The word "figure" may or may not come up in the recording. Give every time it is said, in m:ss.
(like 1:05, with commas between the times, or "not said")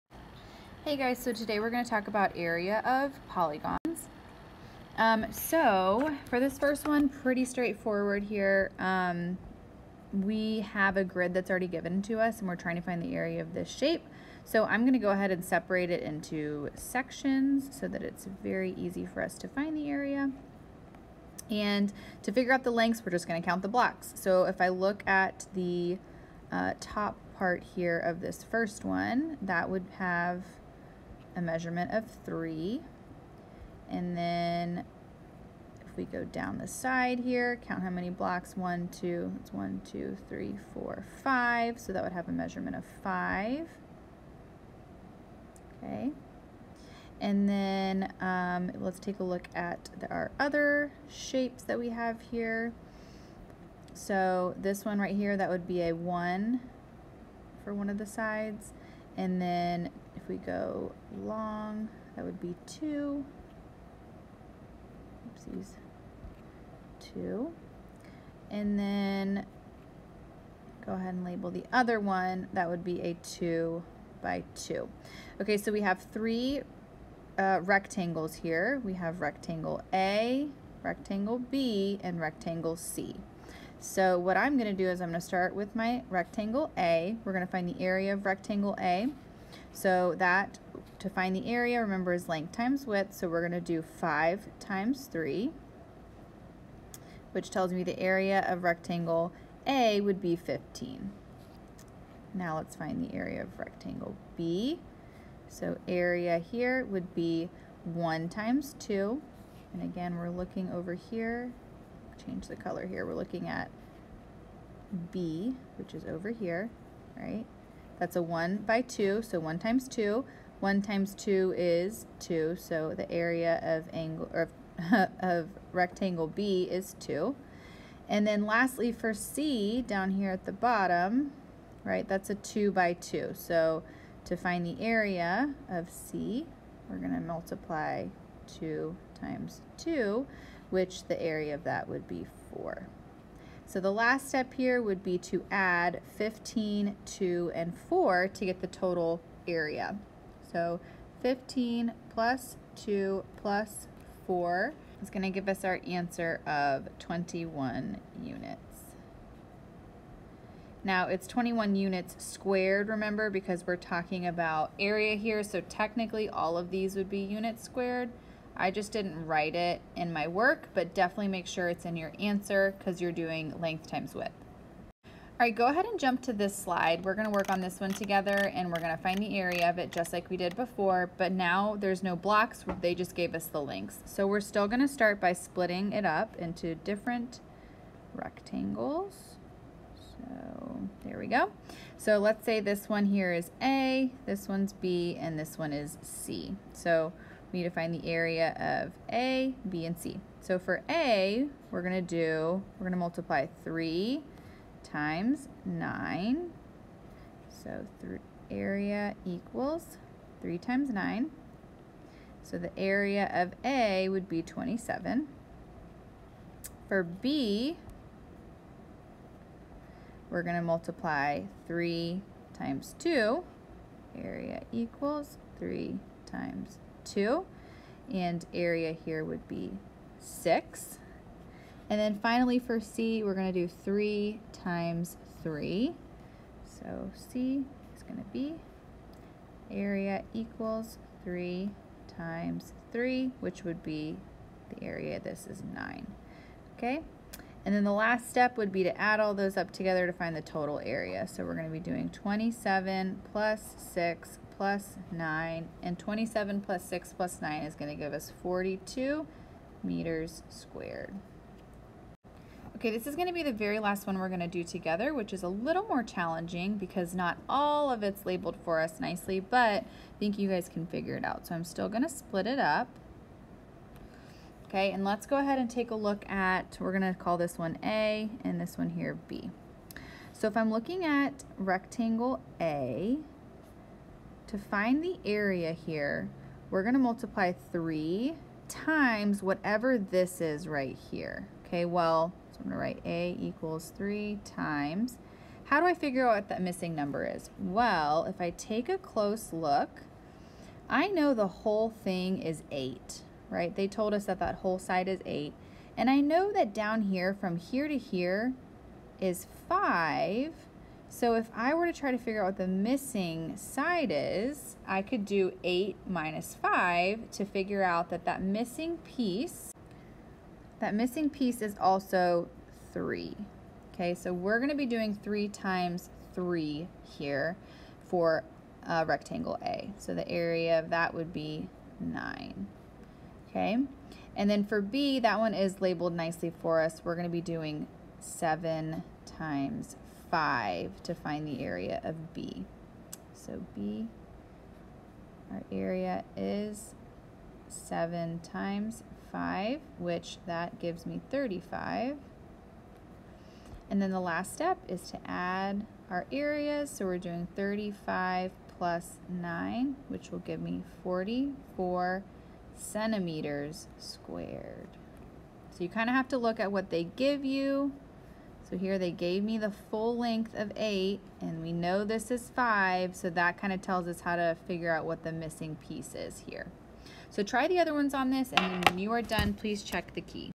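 0:22, 4:30, 4:55, 5:12, 5:17, 6:14.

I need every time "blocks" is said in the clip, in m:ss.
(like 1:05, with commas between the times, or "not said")
0:23, 0:38, 3:02.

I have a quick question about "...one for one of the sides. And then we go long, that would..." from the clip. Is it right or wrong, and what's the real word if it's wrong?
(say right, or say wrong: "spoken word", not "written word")
right.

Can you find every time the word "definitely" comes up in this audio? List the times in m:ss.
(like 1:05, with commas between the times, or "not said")
2:50.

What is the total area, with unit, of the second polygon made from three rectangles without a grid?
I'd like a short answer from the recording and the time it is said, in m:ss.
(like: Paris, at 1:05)
42 meters squared, at 4:18.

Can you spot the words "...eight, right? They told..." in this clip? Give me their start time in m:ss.
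5:02.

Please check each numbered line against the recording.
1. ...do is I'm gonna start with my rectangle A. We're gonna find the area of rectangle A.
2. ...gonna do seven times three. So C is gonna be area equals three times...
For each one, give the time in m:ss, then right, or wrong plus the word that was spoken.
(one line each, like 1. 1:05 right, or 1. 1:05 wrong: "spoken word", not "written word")
1. 1:24 right
2. 3:53 wrong: "three", not "seven".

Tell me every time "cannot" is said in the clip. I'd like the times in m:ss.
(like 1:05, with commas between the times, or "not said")
not said.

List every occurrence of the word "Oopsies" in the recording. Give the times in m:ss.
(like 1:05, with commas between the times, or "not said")
1:05.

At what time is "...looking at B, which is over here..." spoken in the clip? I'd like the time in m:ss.
1:53.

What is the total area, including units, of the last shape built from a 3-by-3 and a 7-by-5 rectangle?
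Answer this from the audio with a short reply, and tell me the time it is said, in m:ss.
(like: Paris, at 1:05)
44 centimeters squared, at 6:01.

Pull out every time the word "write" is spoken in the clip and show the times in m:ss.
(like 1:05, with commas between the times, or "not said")
2:49, 4:52.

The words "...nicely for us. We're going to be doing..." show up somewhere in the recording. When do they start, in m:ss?
5:36.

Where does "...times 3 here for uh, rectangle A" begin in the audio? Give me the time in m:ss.
5:25.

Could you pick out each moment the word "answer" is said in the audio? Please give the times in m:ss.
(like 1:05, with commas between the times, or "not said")
2:35, 2:52.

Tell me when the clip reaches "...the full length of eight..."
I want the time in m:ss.
6:09.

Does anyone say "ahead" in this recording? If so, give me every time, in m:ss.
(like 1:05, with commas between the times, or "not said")
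0:15, 1:10, 2:55, 4:35.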